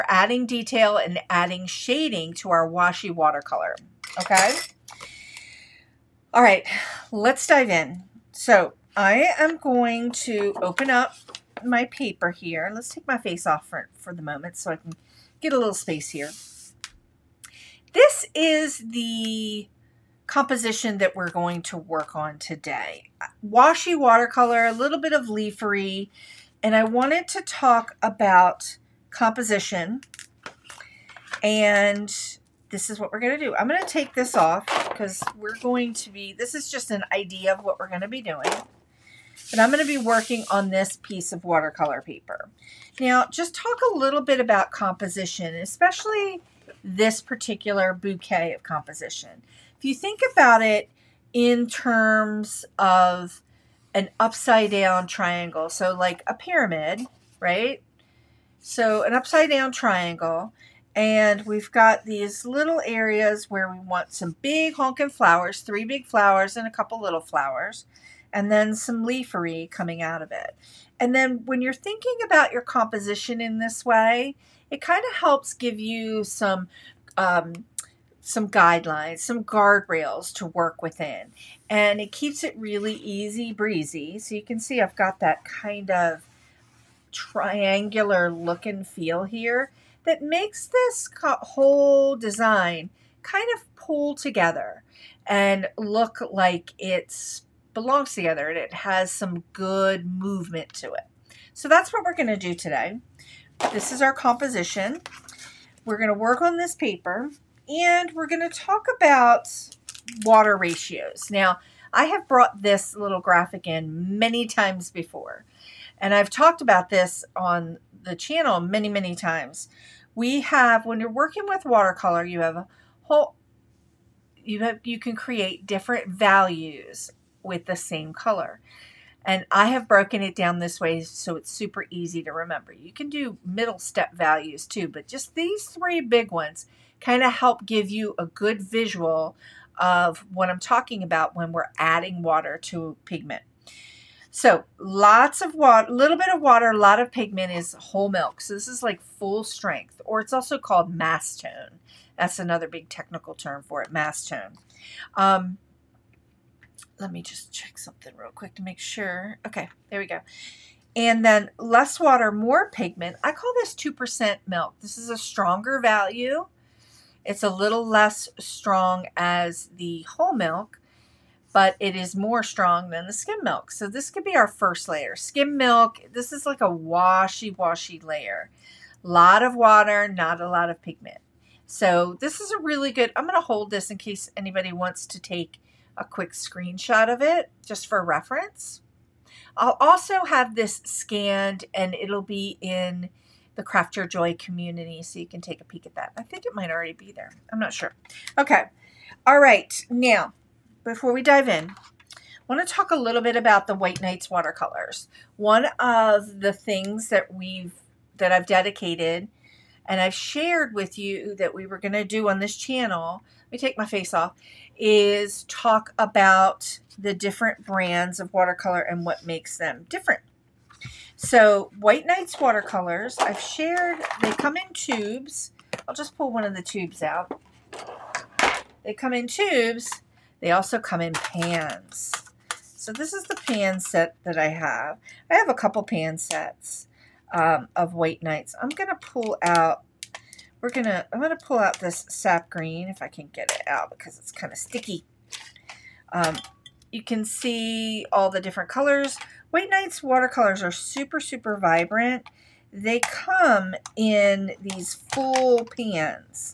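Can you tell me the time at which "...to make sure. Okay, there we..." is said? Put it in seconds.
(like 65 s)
158 s.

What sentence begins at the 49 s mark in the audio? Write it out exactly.
If you think about it in terms of an upside down triangle, so like a pyramid, right?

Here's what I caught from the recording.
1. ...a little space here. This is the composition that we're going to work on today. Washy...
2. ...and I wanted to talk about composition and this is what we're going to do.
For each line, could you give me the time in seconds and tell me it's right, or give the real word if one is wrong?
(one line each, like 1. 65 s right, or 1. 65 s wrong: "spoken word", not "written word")
1. 15 s right
2. 26 s right.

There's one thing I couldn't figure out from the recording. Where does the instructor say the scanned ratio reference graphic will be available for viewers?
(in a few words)
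Craft Your Joy community.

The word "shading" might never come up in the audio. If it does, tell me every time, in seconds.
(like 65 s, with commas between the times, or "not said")
1 s.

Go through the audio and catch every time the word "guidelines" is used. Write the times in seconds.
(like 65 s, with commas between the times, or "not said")
78 s.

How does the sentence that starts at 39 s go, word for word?
But I'm going to be working on this piece of watercolor paper.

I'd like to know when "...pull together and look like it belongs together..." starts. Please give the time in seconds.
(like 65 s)
93 s.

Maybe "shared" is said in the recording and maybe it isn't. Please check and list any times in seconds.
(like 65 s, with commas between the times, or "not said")
210 s, 223 s.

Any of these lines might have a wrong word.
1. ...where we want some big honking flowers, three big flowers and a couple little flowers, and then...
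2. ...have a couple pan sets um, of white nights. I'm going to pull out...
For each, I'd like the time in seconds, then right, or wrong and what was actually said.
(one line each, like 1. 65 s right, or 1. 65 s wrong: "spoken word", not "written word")
1. 63 s right
2. 235 s right.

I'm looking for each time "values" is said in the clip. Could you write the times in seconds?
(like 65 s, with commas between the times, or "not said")
126 s, 134 s, 165 s.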